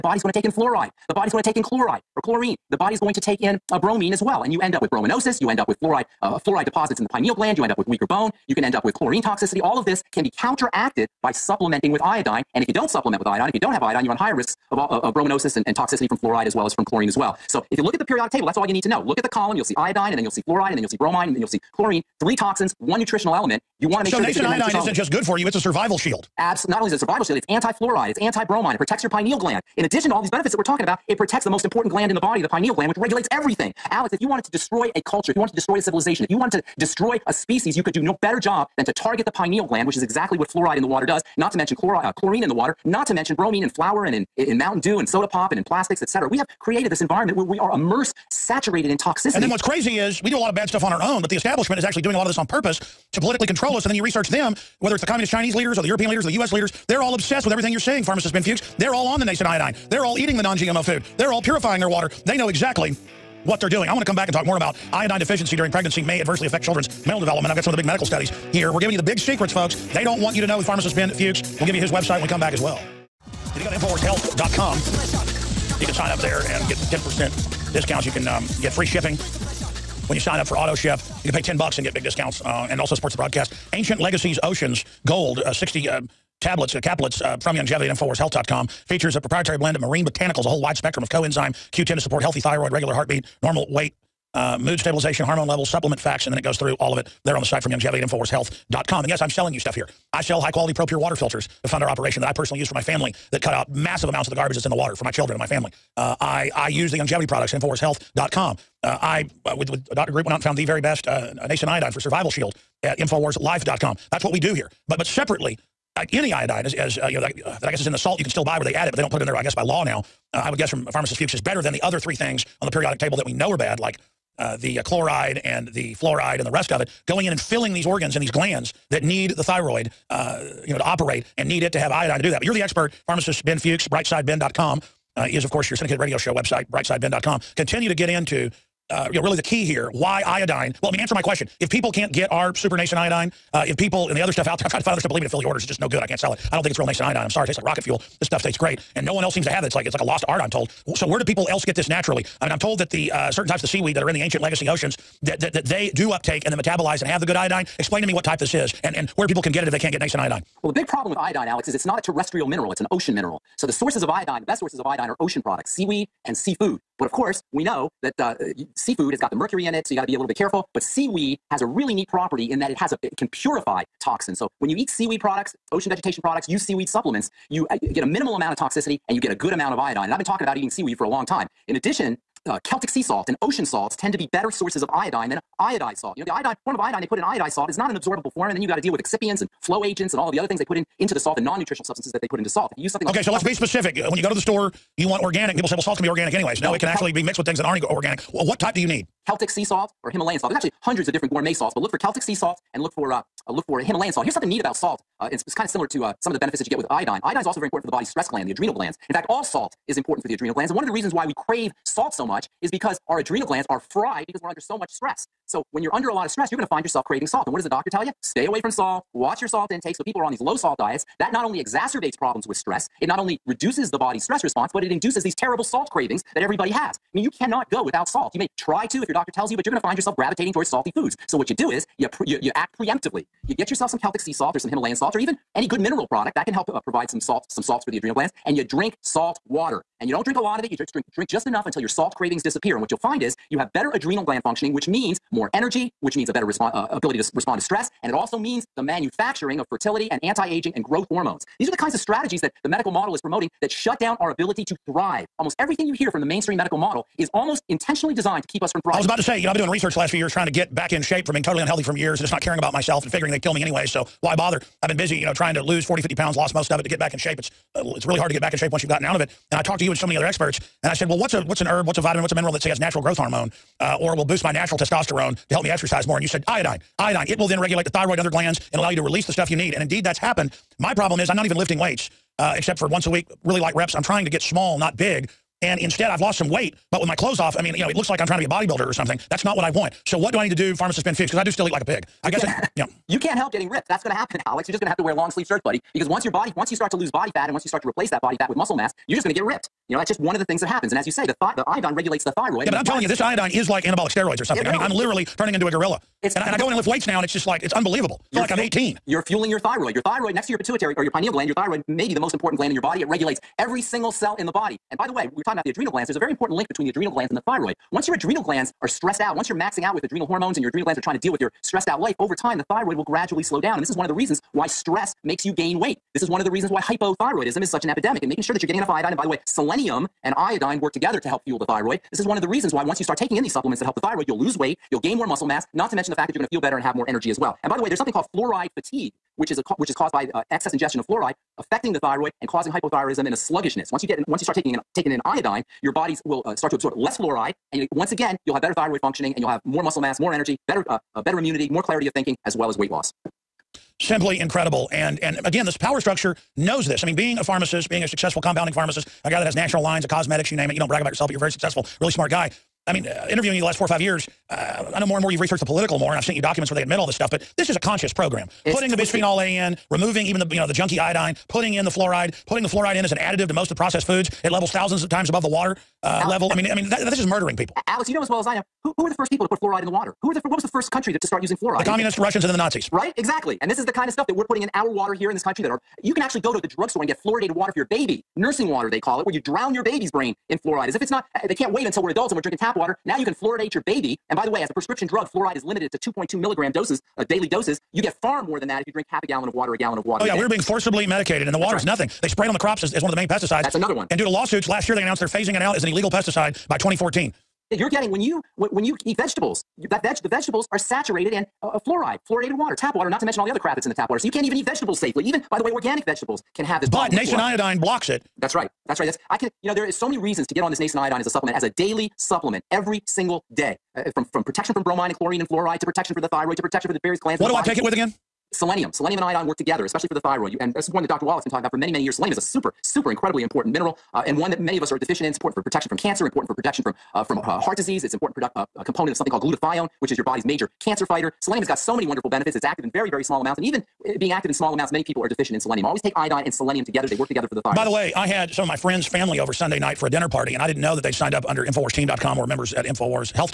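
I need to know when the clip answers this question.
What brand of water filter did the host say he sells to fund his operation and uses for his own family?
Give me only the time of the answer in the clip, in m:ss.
1:40.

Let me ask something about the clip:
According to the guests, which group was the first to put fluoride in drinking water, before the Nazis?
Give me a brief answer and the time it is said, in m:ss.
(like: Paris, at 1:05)
The communist Russians, at 6:21.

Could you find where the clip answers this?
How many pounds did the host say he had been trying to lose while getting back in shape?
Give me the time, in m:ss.
4:25.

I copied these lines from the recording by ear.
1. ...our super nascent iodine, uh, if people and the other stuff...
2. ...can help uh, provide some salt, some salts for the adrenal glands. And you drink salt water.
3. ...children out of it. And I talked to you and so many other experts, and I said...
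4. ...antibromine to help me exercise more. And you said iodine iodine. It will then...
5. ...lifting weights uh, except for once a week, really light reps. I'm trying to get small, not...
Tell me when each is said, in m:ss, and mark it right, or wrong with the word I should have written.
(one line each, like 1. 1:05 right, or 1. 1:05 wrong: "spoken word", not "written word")
1. 2:22 right
2. 3:56 right
3. 4:28 wrong: "gotten", not "children"
4. 4:34 wrong: "testosterone", not "antibromine"
5. 4:41 right.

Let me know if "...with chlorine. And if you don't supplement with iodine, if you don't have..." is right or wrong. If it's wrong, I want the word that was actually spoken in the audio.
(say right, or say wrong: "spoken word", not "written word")
wrong: "iodine", not "chlorine".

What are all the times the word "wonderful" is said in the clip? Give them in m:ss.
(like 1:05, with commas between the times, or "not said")
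7:22.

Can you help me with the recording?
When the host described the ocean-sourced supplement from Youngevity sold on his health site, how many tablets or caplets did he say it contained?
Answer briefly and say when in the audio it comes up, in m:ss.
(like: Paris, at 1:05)
60, at 1:25.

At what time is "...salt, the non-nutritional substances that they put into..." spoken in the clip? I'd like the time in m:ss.
3:11.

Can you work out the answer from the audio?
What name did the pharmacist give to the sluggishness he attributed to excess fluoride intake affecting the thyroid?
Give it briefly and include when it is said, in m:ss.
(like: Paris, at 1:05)
Fluoride fatigue, at 5:38.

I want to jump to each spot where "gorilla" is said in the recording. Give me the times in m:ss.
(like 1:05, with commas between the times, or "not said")
5:05.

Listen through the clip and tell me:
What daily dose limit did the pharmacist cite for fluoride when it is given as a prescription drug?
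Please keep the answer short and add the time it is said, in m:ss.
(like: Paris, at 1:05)
2.2 milligrams, at 6:35.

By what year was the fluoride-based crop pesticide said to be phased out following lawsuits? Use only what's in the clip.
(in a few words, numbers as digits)
2014.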